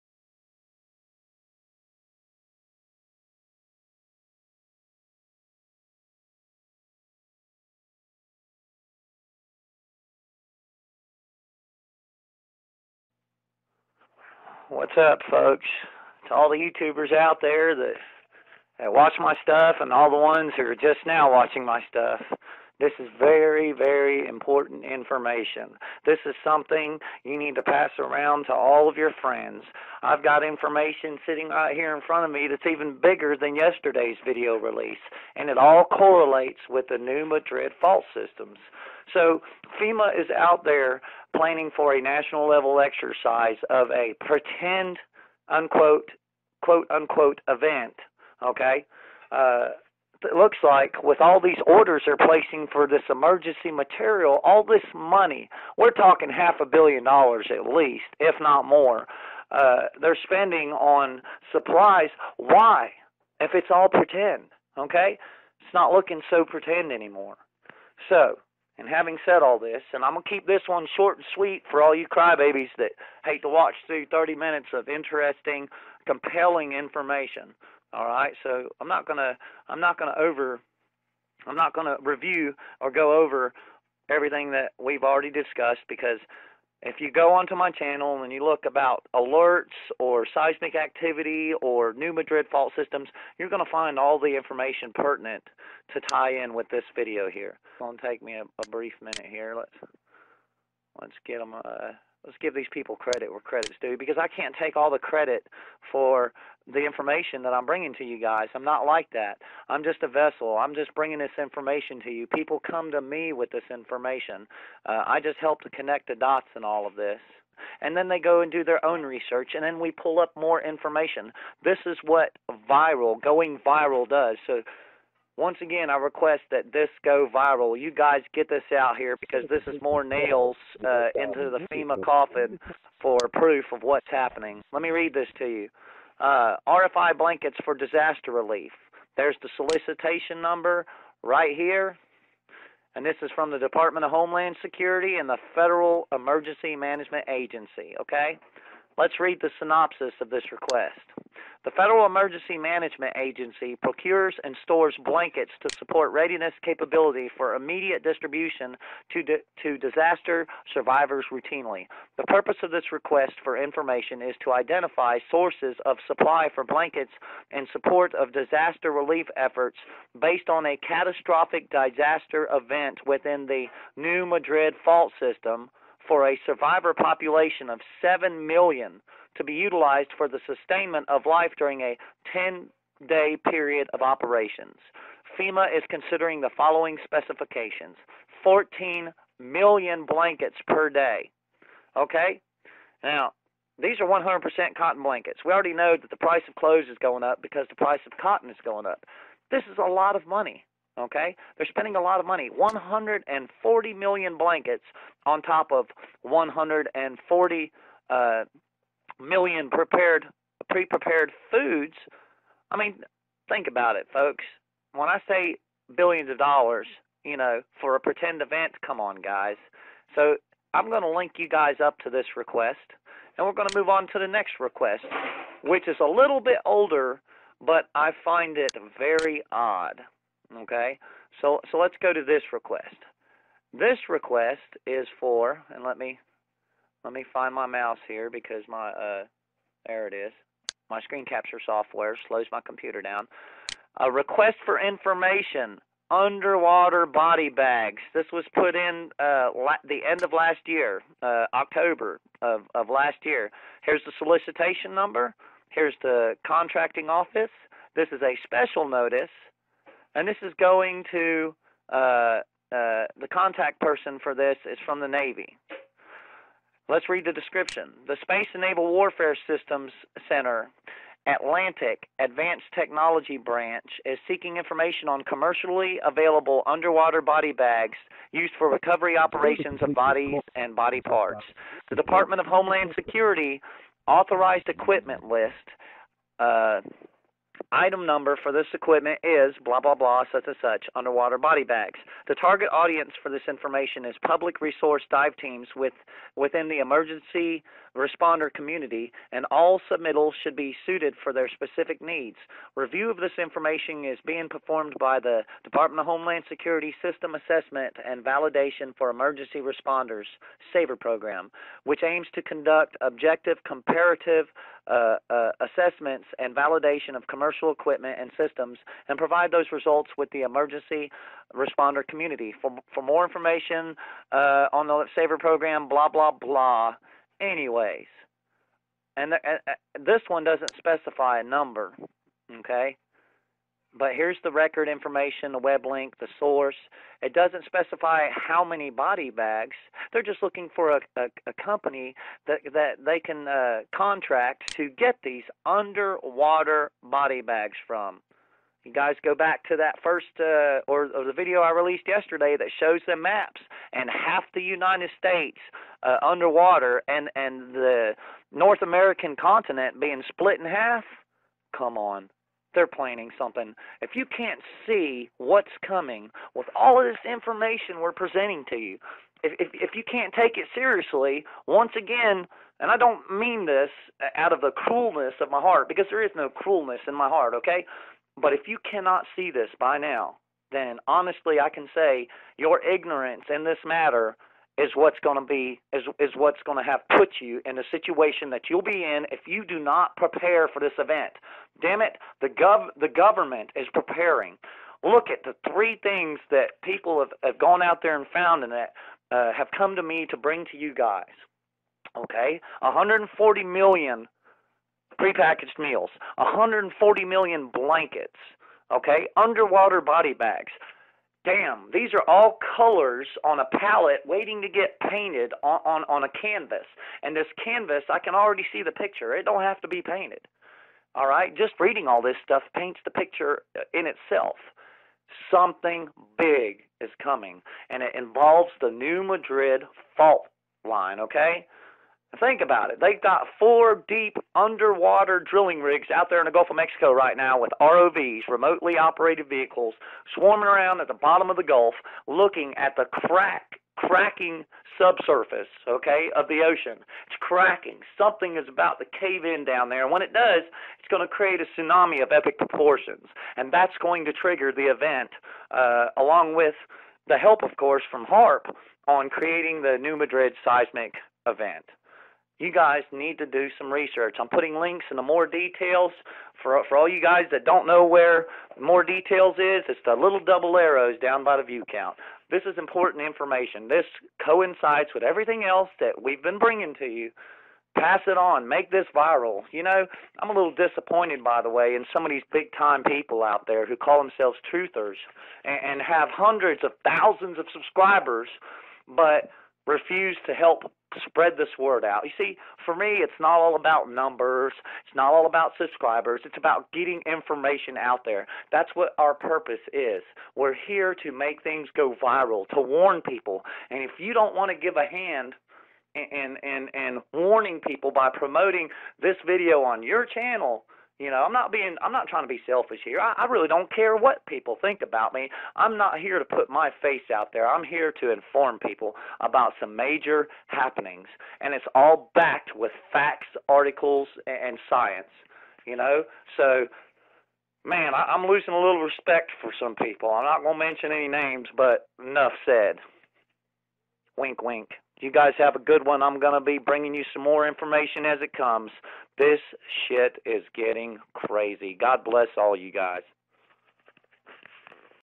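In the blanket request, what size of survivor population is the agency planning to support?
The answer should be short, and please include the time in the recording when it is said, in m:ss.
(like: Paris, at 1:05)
7 million, at 2:58.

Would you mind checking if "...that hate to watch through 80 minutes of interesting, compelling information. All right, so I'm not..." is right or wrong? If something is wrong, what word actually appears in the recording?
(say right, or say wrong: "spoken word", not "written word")
wrong: "30", not "80".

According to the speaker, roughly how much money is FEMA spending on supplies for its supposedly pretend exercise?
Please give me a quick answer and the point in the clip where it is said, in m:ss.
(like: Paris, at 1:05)
half a billion dollars, at 0:56.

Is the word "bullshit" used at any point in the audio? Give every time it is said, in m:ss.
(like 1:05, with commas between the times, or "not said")
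not said.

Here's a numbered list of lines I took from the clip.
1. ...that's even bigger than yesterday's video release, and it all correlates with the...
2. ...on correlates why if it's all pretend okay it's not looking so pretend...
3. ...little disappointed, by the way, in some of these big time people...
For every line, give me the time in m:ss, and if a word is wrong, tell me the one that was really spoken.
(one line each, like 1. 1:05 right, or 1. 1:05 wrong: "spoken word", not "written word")
1. 0:32 right
2. 1:00 wrong: "supplies", not "correlates"
3. 8:00 right.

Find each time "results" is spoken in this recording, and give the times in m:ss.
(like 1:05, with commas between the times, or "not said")
5:19.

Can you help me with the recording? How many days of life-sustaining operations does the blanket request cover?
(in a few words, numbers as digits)
10.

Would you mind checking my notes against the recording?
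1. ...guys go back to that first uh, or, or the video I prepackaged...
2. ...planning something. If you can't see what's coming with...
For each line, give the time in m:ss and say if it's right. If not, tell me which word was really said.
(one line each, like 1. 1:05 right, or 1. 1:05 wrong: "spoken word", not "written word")
1. 5:48 wrong: "released", not "prepackaged"
2. 6:02 right.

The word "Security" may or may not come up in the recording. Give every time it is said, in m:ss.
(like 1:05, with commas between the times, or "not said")
2:24, 4:42, 5:06.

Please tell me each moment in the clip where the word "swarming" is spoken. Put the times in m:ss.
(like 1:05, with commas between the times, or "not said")
7:20.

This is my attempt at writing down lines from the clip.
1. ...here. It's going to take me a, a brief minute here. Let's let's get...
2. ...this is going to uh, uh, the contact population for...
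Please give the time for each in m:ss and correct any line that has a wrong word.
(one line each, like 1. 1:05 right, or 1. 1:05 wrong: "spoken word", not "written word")
1. 1:37 right
2. 4:20 wrong: "person", not "population".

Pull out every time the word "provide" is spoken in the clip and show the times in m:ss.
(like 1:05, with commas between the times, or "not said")
5:19.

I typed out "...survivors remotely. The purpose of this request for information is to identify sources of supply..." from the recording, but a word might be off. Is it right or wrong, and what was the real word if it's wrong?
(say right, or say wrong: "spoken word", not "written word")
wrong: "routinely", not "remotely".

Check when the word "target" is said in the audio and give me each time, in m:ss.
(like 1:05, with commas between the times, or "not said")
4:52.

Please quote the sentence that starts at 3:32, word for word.
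I mean, think about it, folks.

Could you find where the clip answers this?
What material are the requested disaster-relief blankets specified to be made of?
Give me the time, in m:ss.
3:14.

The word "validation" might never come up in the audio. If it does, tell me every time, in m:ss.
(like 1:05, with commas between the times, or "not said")
5:08, 5:16.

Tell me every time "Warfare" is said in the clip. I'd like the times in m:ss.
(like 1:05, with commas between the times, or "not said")
4:28.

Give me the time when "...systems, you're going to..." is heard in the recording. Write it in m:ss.
1:32.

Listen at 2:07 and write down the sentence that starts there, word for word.
You guys get this out here because this is more nails uh, into the FEMA coffin for proof of what's happening.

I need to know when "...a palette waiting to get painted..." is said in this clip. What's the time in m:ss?
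6:53.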